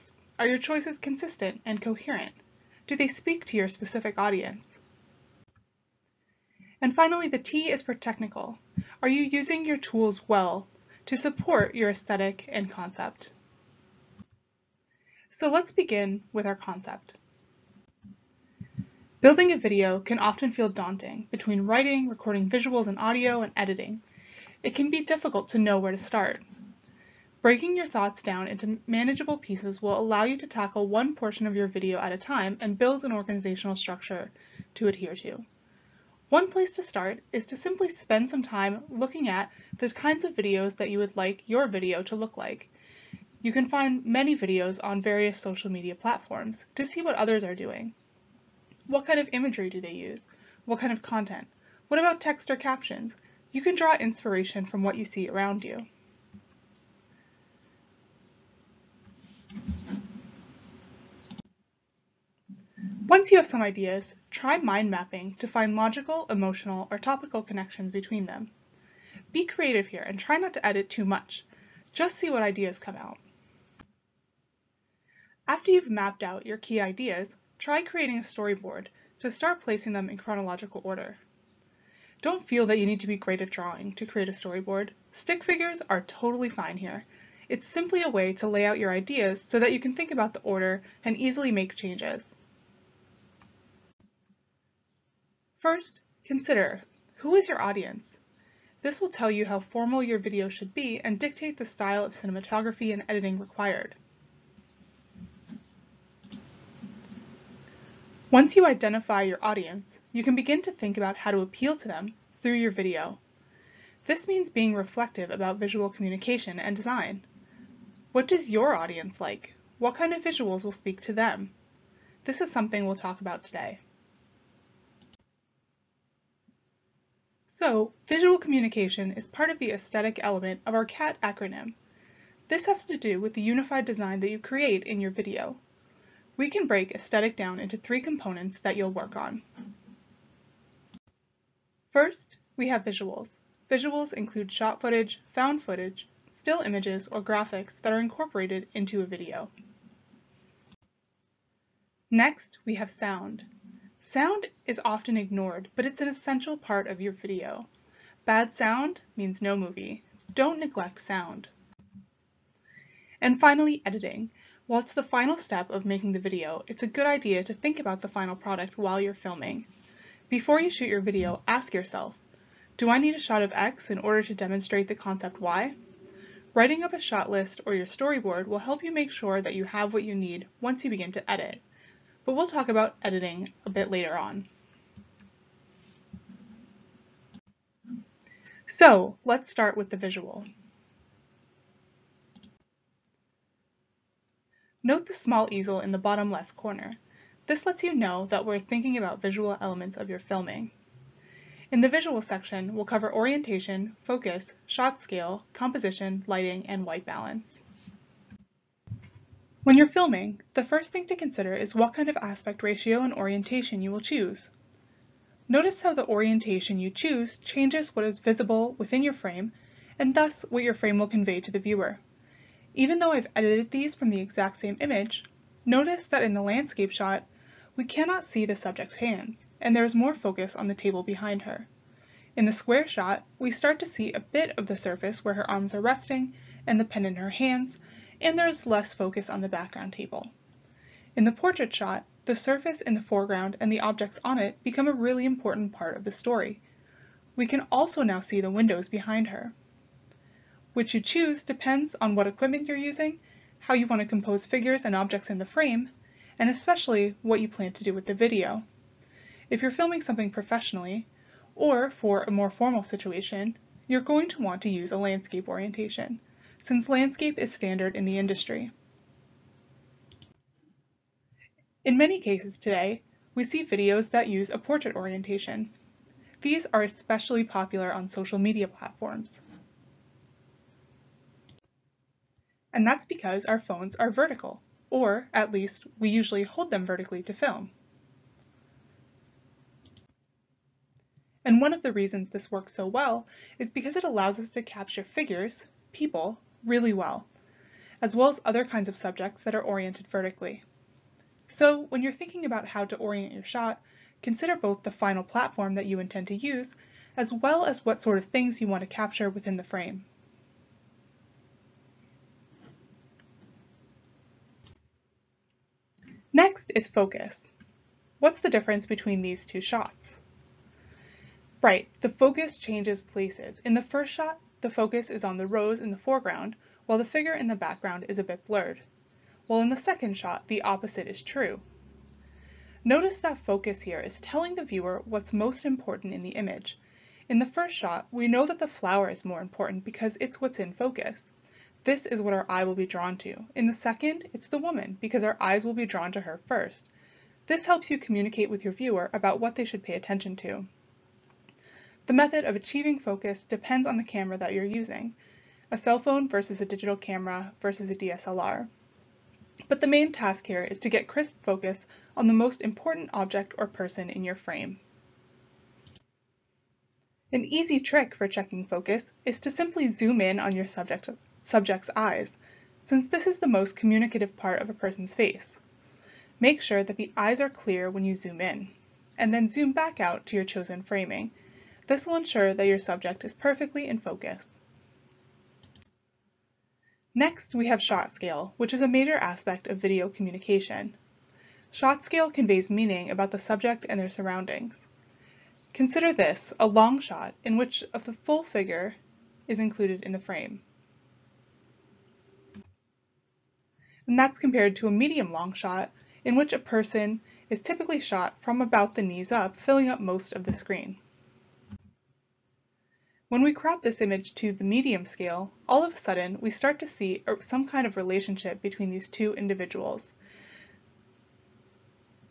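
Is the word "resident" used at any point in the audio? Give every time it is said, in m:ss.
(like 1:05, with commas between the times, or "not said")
not said.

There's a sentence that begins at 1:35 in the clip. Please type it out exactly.
First, consider, who is your audience?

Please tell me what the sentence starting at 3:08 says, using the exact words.
So let's start with the visual.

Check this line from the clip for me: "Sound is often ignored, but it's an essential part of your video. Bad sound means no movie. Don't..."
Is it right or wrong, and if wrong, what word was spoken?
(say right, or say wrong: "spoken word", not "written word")
right.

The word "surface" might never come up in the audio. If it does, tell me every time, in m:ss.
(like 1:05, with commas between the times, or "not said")
3:54, 4:02.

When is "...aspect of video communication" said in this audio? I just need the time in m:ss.
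6:29.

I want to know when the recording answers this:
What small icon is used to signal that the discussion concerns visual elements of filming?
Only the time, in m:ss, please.
3:15.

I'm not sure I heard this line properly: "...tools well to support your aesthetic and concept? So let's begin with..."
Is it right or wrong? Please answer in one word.
right.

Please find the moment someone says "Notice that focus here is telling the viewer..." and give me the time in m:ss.
5:32.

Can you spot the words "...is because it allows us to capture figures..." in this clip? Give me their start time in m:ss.
4:53.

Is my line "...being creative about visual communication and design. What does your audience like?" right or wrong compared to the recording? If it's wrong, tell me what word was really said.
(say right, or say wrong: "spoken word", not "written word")
wrong: "reflective", not "creative".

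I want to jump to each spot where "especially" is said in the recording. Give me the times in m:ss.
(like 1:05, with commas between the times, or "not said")
4:16, 4:36.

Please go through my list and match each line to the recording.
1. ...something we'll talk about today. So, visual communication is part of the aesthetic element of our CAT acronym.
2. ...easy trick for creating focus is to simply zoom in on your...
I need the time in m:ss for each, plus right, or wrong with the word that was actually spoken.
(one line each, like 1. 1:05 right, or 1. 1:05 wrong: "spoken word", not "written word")
1. 2:02 right
2. 6:07 wrong: "checking", not "creating".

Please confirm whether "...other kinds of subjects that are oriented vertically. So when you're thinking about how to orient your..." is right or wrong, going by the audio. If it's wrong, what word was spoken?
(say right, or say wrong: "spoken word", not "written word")
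right.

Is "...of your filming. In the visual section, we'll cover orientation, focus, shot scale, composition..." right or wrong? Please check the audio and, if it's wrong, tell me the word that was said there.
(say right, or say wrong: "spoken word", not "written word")
right.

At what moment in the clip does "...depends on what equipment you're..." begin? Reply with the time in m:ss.
4:11.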